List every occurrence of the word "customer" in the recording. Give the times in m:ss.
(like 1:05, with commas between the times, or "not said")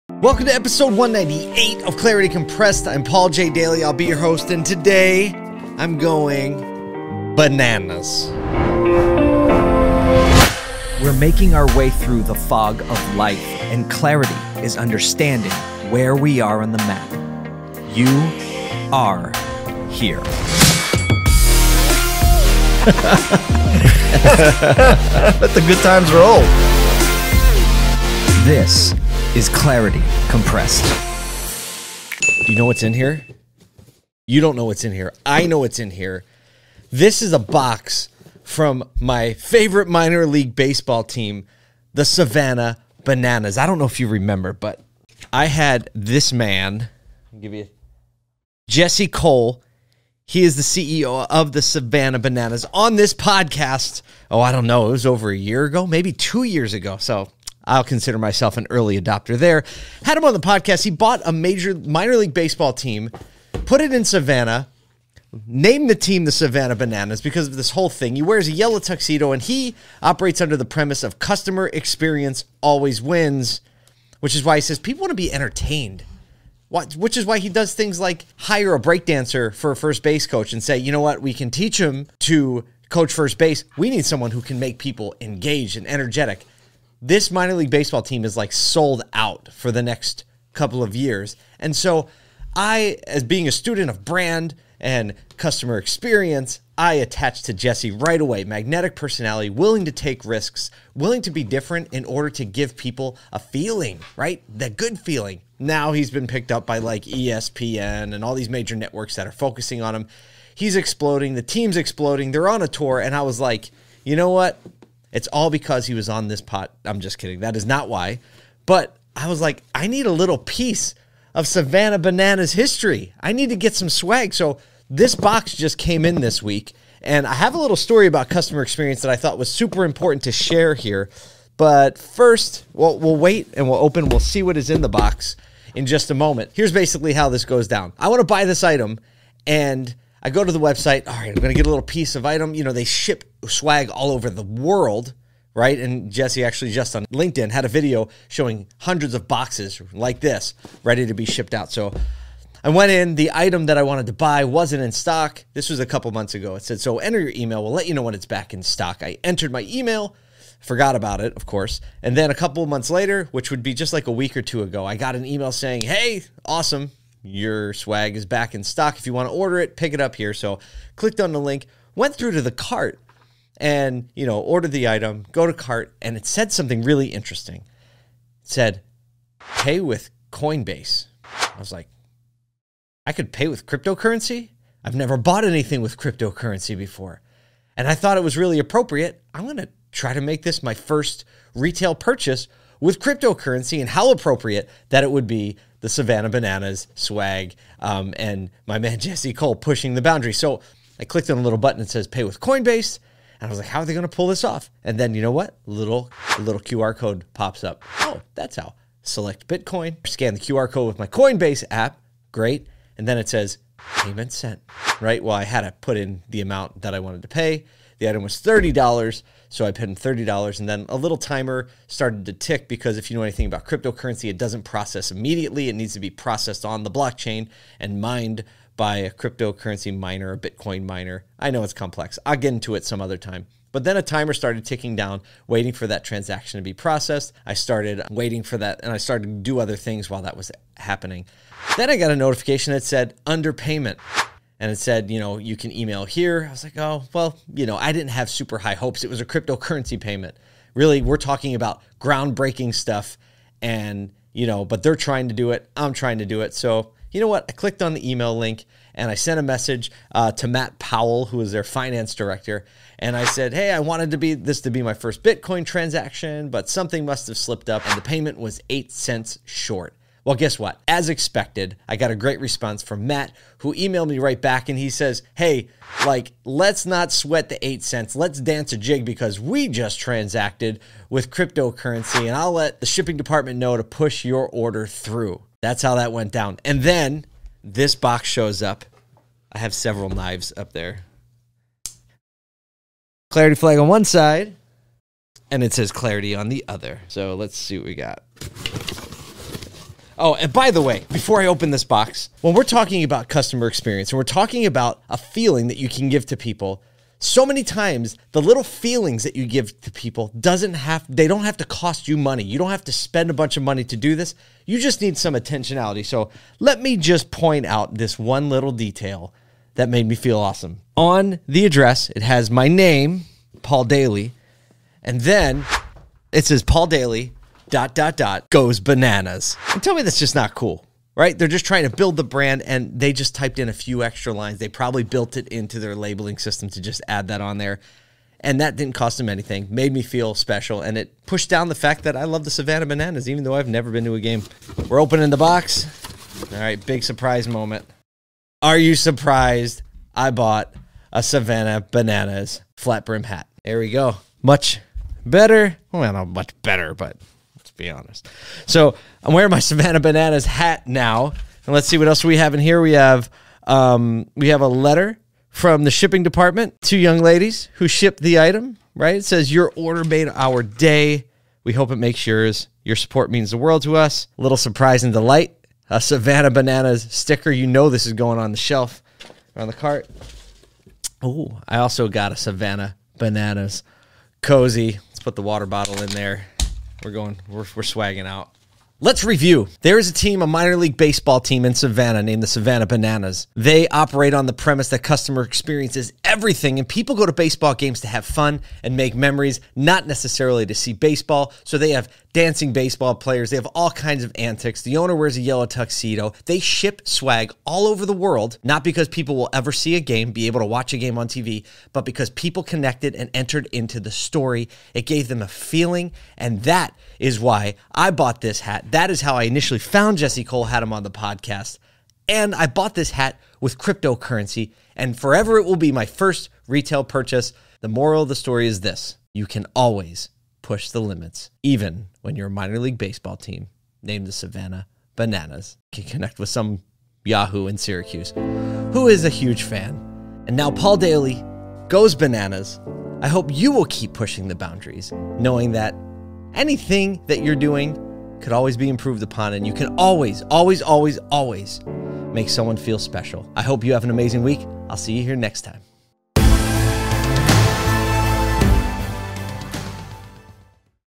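1:11, 1:35, 2:08, 5:03, 6:34.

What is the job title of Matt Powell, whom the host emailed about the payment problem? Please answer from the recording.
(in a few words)
finance director.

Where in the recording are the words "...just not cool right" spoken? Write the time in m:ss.
5:30.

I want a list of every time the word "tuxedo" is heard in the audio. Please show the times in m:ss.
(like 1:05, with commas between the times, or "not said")
1:08, 6:45.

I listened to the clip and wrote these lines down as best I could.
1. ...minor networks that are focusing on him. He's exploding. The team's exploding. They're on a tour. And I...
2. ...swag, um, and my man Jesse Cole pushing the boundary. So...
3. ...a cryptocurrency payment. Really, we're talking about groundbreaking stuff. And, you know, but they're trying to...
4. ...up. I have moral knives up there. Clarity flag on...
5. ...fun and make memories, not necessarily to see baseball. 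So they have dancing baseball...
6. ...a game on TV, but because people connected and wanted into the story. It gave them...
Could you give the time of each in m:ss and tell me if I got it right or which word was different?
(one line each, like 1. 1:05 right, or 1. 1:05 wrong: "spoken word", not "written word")
1. 1:48 wrong: "major", not "minor"
2. 3:16 right
3. 4:09 right
4. 4:48 wrong: "several", not "moral"
5. 6:38 right
6. 6:50 wrong: "entered", not "wanted".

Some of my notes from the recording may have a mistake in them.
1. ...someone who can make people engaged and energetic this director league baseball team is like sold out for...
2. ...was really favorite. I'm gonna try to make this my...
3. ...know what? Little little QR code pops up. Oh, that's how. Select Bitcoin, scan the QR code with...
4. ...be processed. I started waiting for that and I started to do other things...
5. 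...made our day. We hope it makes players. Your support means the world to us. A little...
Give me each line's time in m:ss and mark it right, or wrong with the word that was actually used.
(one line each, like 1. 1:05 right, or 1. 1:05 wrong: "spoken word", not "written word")
1. 1:24 wrong: "minor", not "director"
2. 3:08 wrong: "appropriate", not "favorite"
3. 3:25 right
4. 3:56 right
5. 6:10 wrong: "yours", not "players".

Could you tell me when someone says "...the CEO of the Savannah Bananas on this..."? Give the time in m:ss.
0:50.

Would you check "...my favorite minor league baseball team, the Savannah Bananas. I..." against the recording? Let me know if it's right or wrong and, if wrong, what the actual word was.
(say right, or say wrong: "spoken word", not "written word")
right.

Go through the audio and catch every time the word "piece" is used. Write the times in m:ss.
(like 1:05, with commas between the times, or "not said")
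2:00, 2:21.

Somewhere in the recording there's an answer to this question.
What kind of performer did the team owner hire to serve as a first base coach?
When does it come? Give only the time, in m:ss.
1:18.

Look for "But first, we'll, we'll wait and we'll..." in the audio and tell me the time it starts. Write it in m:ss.
2:11.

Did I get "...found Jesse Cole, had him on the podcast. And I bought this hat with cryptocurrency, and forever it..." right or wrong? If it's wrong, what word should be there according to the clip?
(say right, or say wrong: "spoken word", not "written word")
right.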